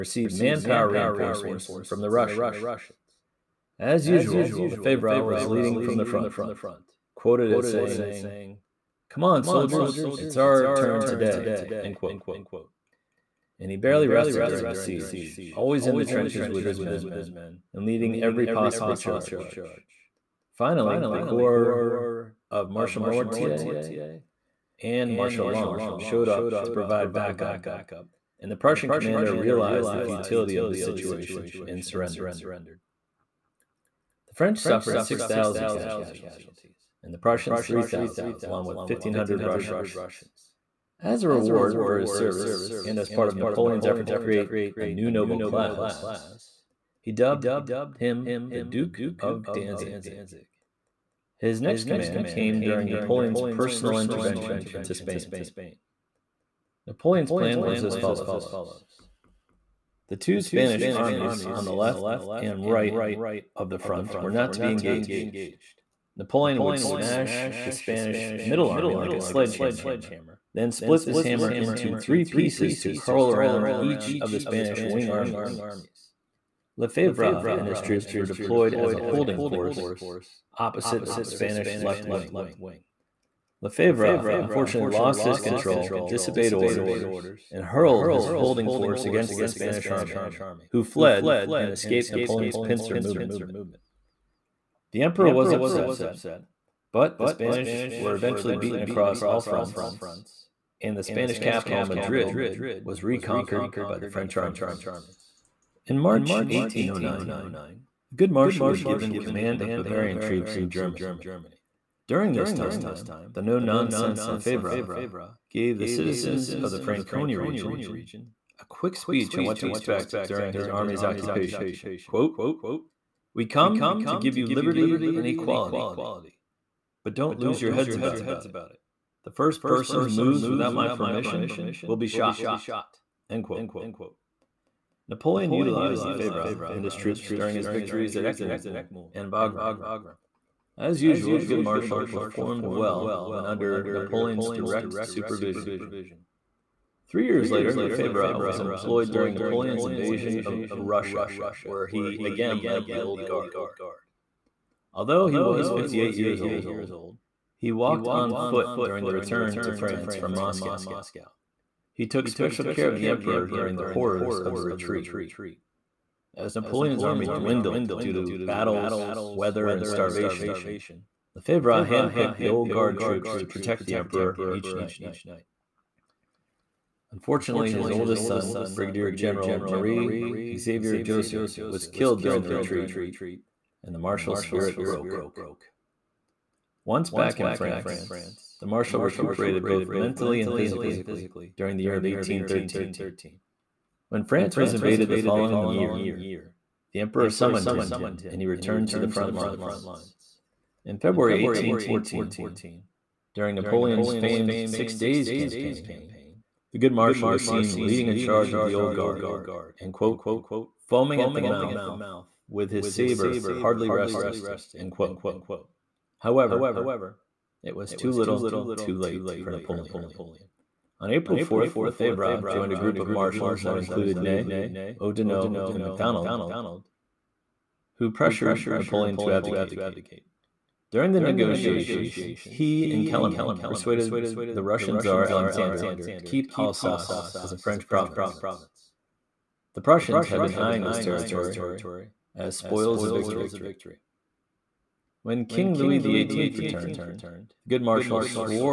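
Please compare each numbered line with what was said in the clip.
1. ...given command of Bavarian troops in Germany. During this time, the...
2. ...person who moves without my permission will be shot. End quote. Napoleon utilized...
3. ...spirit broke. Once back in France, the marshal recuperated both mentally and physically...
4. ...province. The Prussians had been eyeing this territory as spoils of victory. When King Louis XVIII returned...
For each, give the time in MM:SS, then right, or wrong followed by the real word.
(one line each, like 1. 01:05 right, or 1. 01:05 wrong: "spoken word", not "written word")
1. 01:48 right
2. 02:09 right
3. 03:04 right
4. 03:57 right.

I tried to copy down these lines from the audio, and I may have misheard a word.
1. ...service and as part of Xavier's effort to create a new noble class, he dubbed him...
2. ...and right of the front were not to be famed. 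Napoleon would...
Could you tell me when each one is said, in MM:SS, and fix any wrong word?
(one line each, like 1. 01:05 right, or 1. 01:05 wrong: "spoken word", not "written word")
1. 00:42 wrong: "Napoleon", not "Xavier"
2. 01:02 wrong: "engaged", not "famed".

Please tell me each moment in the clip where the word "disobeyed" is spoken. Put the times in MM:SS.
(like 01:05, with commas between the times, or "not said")
01:26.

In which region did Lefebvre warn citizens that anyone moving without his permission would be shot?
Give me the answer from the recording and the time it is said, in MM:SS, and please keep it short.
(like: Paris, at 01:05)
Franconia, at 01:56.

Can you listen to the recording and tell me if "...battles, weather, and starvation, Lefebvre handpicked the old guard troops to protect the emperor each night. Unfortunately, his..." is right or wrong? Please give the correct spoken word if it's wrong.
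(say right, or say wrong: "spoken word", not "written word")
right.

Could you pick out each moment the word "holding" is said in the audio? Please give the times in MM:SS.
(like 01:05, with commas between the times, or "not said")
01:18, 01:28.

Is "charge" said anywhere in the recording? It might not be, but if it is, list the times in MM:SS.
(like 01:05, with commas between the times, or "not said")
00:18, 03:28.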